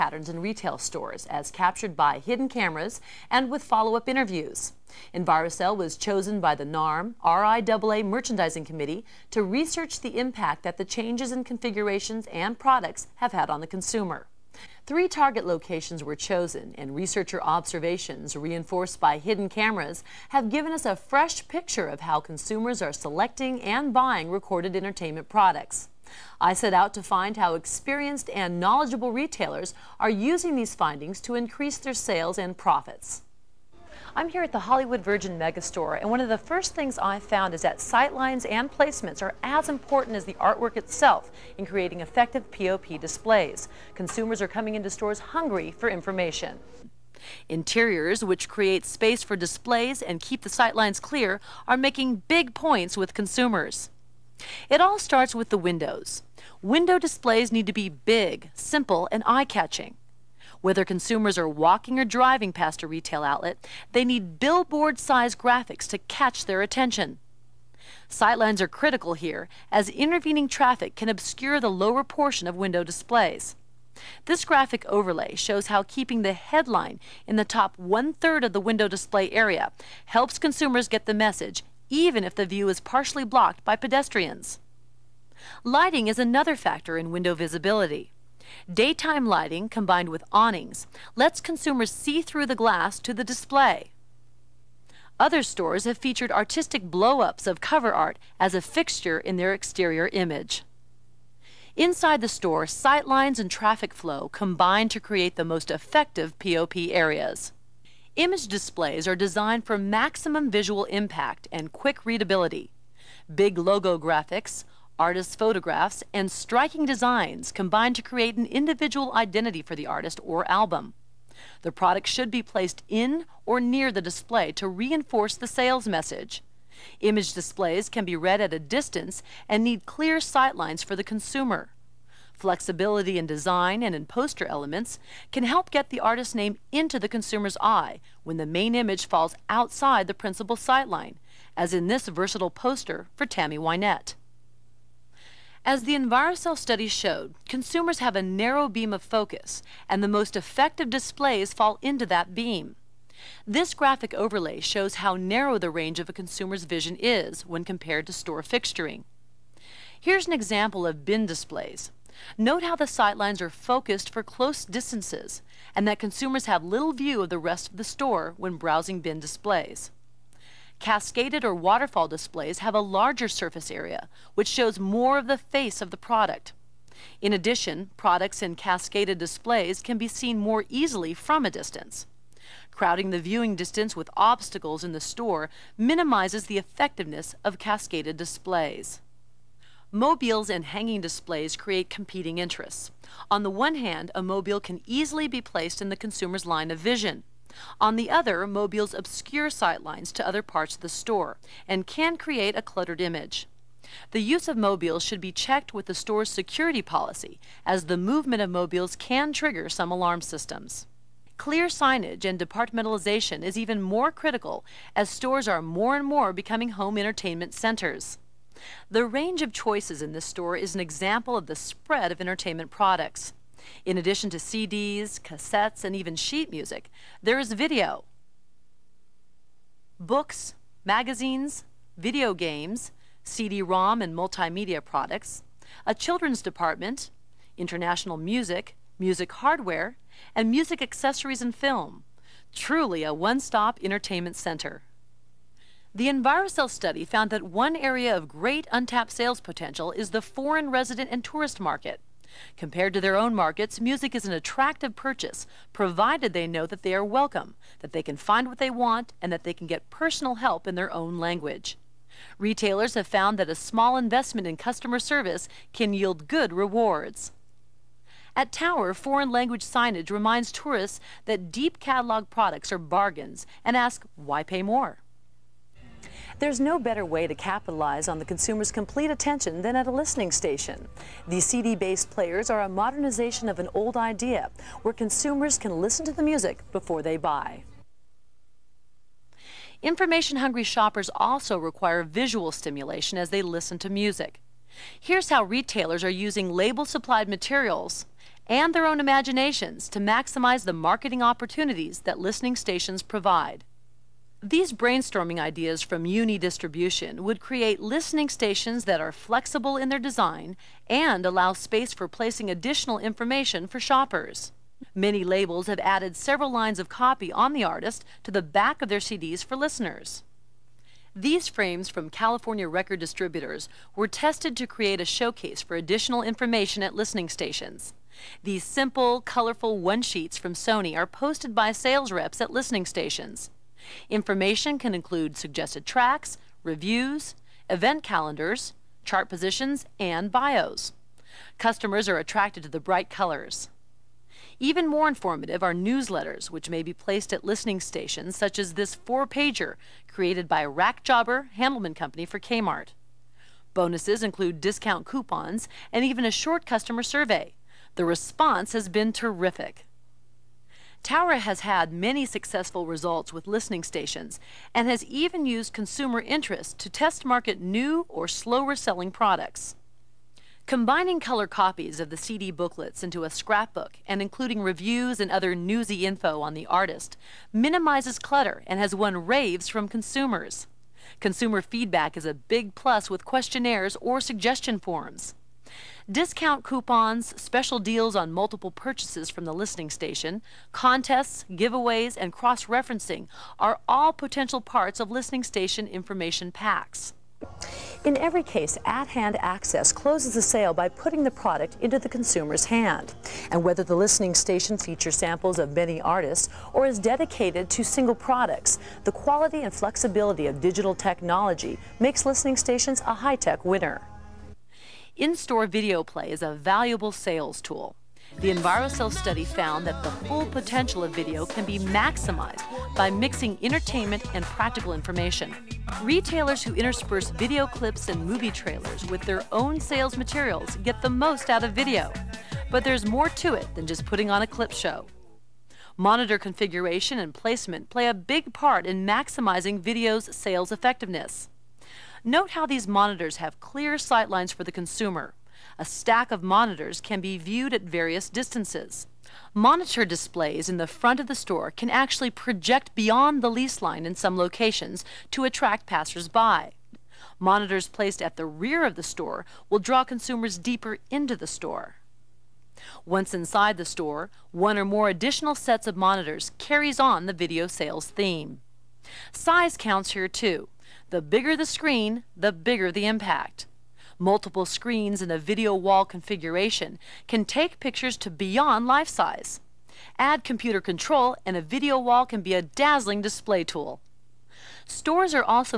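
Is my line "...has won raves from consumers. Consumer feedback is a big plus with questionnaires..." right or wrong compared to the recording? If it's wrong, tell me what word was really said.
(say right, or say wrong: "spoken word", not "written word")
right.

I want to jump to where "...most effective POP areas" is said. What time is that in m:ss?
1:45.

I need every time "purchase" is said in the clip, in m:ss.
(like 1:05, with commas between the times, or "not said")
4:14, 6:28.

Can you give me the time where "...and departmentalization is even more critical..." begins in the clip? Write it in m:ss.
3:32.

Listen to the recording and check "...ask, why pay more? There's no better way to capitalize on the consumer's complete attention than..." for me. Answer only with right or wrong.
right.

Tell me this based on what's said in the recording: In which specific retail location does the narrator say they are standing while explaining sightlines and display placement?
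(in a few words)
Hollywood Virgin Megastore.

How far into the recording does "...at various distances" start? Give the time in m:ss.
7:27.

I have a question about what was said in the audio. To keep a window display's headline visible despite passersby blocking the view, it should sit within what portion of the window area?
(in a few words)
top one-third.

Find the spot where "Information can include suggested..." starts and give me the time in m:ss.
5:34.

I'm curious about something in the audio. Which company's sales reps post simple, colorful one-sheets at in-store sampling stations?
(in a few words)
Sony.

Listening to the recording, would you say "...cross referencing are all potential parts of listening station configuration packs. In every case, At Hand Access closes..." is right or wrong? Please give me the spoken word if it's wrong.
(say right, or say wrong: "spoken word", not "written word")
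wrong: "information", not "configuration".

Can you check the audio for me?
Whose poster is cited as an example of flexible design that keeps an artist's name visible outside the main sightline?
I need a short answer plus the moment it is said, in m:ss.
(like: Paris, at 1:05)
Tammy Wynette, at 2:23.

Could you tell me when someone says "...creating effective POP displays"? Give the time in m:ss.
0:41.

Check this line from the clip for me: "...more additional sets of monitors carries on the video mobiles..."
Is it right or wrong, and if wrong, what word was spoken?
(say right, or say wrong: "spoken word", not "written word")
wrong: "sales", not "mobiles".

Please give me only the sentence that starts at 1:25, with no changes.
Lighting is another factor in window visibility.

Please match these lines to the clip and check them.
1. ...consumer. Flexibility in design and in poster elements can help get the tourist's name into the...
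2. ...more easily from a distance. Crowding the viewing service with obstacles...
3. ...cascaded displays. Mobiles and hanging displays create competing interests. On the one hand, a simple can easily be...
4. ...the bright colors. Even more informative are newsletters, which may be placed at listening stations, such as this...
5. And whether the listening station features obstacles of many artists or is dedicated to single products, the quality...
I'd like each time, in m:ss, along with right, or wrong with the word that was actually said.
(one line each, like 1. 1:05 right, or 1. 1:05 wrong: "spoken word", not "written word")
1. 2:11 wrong: "artist", not "tourist"
2. 3:00 wrong: "distance", not "service"
3. 3:07 wrong: "mobile", not "simple"
4. 5:42 right
5. 6:43 wrong: "samples", not "obstacles".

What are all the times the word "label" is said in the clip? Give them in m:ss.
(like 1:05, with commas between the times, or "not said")
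4:56, 5:15.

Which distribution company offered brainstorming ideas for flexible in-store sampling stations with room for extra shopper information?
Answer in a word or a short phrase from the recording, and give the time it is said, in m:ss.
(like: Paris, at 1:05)
Uni Distribution, at 5:06.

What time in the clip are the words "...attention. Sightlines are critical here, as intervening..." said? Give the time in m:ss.
1:06.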